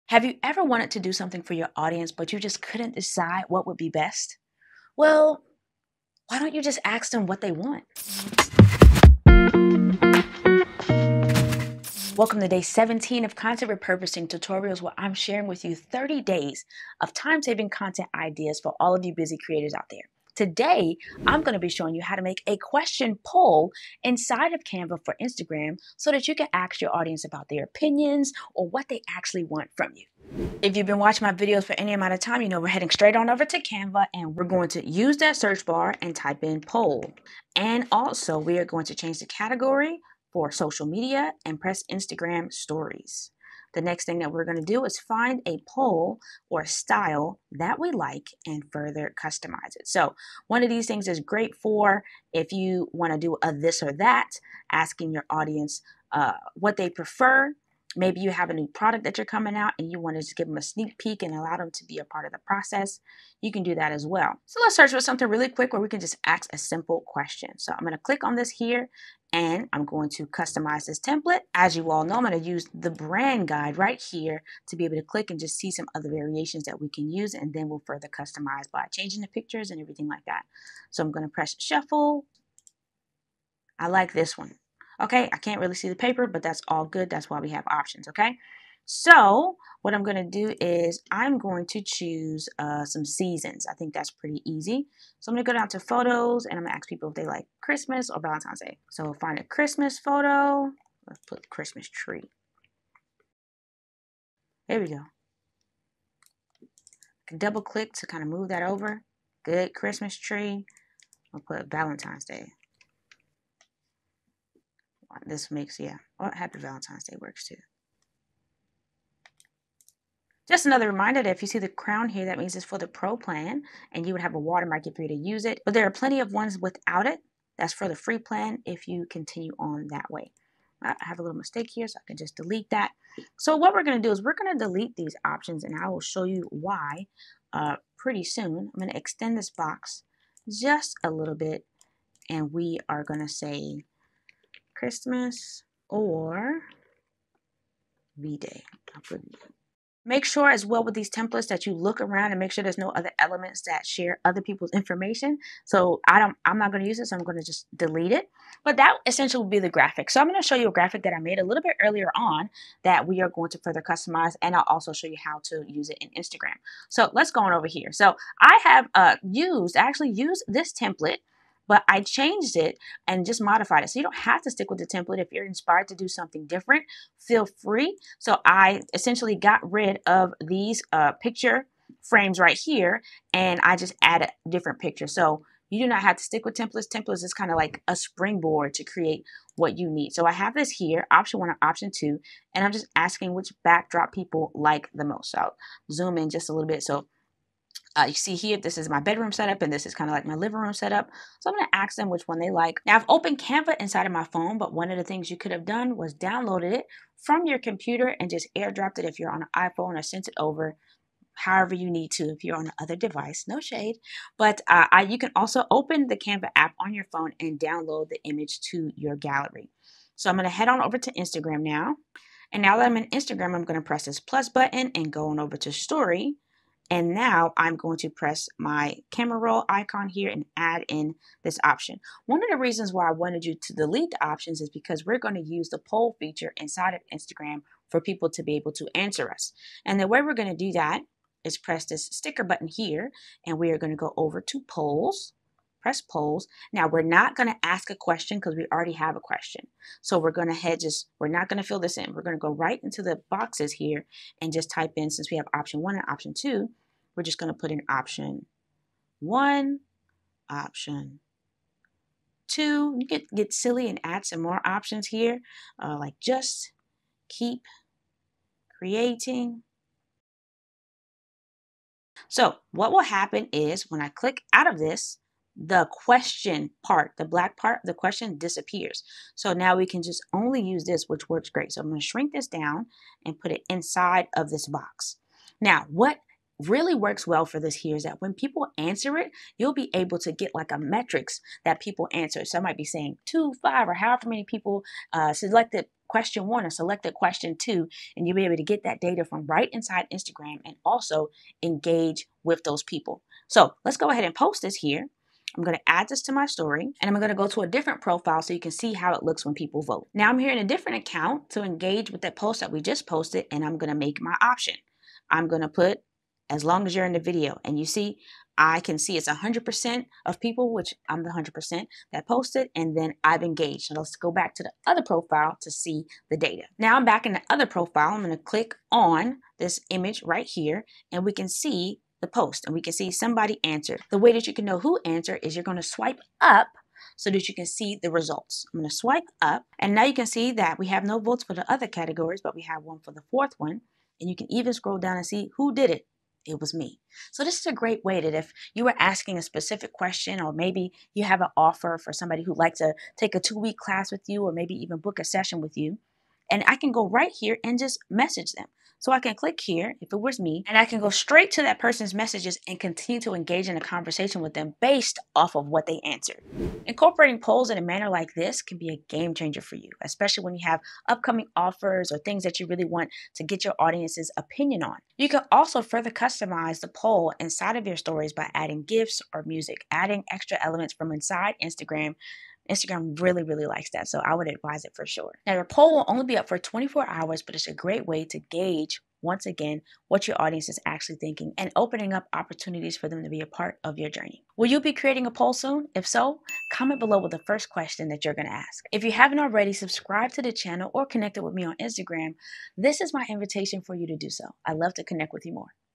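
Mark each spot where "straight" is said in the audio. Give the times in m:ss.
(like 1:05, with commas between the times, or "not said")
0:32, 6:01.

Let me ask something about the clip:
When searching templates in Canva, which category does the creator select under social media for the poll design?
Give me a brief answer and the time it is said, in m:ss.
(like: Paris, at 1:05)
Instagram stories, at 0:41.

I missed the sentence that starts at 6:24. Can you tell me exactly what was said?
So I would advise it for sure.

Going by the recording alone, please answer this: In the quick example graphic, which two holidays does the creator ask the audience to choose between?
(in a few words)
Christmas or Valentine's Day.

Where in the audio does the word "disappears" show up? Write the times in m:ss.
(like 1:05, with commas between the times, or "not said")
4:38.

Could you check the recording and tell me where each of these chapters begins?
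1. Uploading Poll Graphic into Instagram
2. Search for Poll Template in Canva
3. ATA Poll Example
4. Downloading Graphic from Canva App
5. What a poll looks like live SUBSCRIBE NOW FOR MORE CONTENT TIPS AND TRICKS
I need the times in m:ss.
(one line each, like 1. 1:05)
1. 3:43
2. 0:36
3. 2:47
4. 3:27
5. 5:12.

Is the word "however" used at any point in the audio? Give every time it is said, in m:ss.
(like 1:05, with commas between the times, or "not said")
3:31, 4:53.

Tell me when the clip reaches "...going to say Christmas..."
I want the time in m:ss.
2:23.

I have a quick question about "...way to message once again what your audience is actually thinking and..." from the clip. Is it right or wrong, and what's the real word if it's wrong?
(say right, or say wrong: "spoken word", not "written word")
wrong: "gauge", not "message".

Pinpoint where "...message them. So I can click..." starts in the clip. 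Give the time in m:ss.
5:58.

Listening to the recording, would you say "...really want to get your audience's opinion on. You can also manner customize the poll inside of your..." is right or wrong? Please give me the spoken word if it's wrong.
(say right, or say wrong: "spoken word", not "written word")
wrong: "further", not "manner".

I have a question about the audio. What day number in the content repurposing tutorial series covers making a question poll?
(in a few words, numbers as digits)
17.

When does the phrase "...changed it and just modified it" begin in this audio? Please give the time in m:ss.
2:52.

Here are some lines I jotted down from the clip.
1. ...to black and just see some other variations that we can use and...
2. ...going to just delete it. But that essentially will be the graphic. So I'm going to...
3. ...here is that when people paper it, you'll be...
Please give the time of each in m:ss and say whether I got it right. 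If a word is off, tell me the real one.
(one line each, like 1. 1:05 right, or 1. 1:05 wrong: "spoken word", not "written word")
1. 1:14 wrong: "click", not "black"
2. 2:37 right
3. 4:47 wrong: "answer", not "paper".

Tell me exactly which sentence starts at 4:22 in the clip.
You could get silly and add some more options here, uh, like just keep creating.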